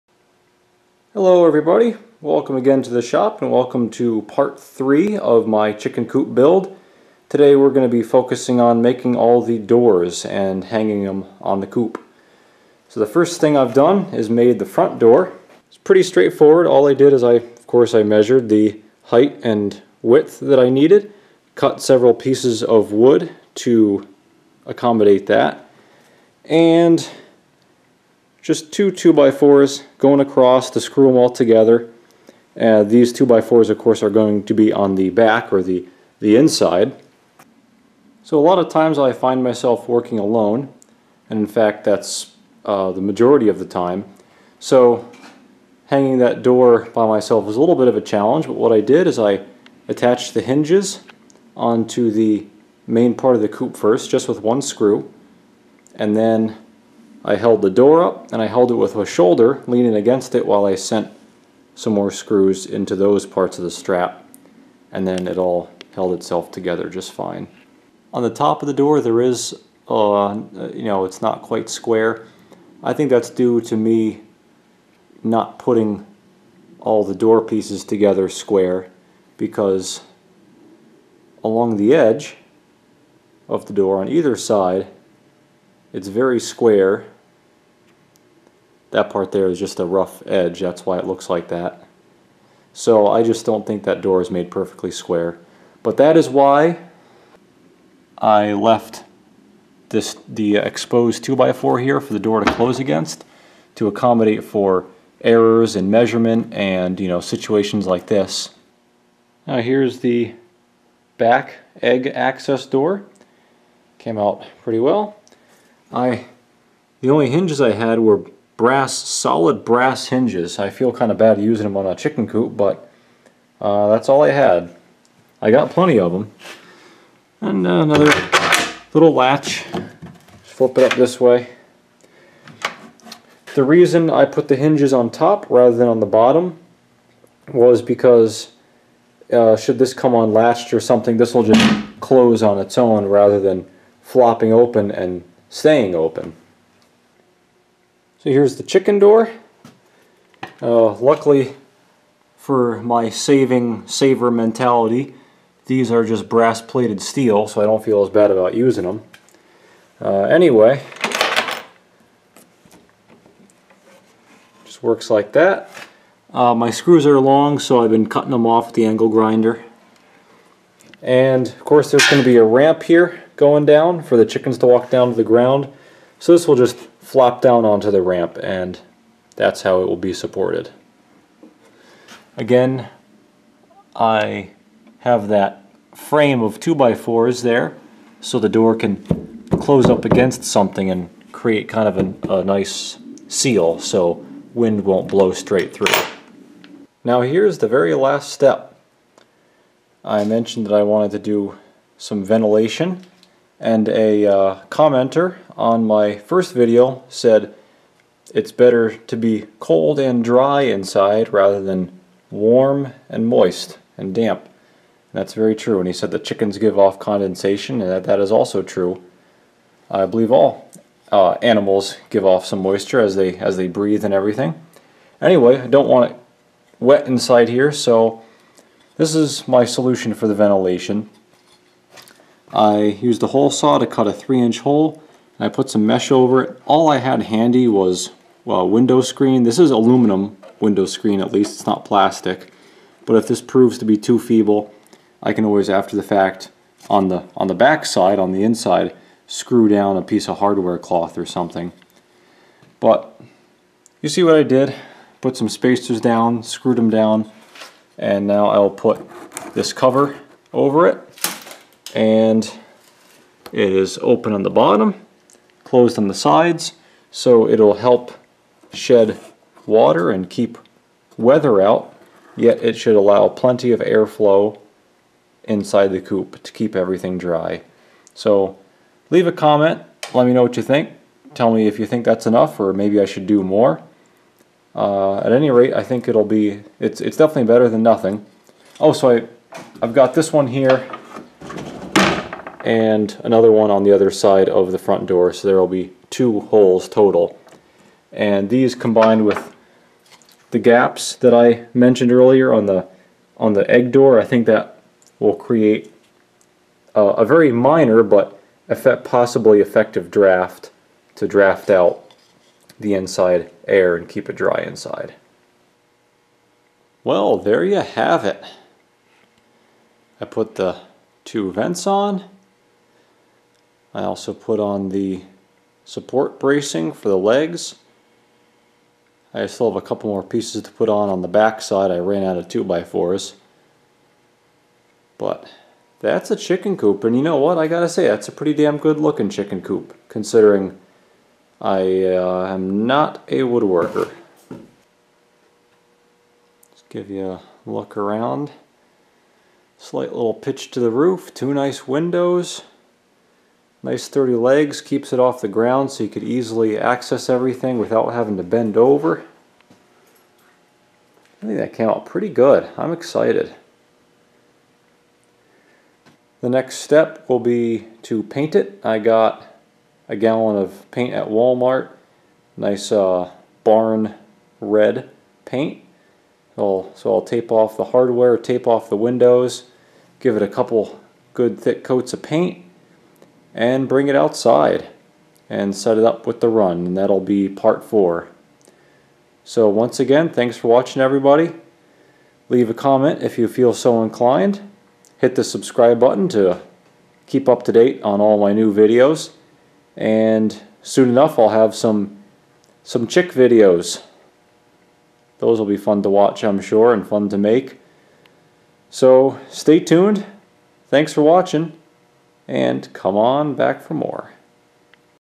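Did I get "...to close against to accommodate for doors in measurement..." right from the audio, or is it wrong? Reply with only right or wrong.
wrong.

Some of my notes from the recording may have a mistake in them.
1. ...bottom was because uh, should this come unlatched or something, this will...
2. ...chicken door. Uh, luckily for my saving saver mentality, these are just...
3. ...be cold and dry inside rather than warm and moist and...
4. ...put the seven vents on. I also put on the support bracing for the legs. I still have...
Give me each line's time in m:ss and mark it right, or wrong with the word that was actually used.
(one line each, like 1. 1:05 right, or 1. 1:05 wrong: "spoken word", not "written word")
1. 2:16 right
2. 2:28 right
3. 3:29 right
4. 5:20 wrong: "two", not "seven".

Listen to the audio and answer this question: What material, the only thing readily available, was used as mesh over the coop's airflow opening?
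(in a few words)
aluminum window screen.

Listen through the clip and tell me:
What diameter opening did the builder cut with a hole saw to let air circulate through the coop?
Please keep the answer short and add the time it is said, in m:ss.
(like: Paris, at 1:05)
3 inch, at 3:54.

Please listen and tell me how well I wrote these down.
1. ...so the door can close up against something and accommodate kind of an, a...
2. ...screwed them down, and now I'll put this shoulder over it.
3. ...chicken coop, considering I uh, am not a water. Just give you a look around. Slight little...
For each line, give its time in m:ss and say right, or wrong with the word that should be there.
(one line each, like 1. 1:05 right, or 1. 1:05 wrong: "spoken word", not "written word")
1. 3:08 wrong: "create", not "accommodate"
2. 4:16 wrong: "cover", not "shoulder"
3. 5:39 wrong: "woodworker", not "water".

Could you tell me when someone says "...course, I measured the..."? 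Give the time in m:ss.
0:17.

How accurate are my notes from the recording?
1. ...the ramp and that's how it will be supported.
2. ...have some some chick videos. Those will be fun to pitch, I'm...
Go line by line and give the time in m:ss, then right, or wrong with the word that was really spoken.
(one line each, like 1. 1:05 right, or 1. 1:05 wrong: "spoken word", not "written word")
1. 2:57 right
2. 6:41 wrong: "watch", not "pitch".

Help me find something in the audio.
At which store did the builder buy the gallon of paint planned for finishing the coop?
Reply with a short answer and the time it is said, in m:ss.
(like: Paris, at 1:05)
Walmart, at 6:11.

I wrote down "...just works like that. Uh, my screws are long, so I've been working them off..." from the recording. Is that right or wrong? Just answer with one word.
wrong.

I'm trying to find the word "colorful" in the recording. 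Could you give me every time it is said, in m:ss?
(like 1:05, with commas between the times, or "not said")
not said.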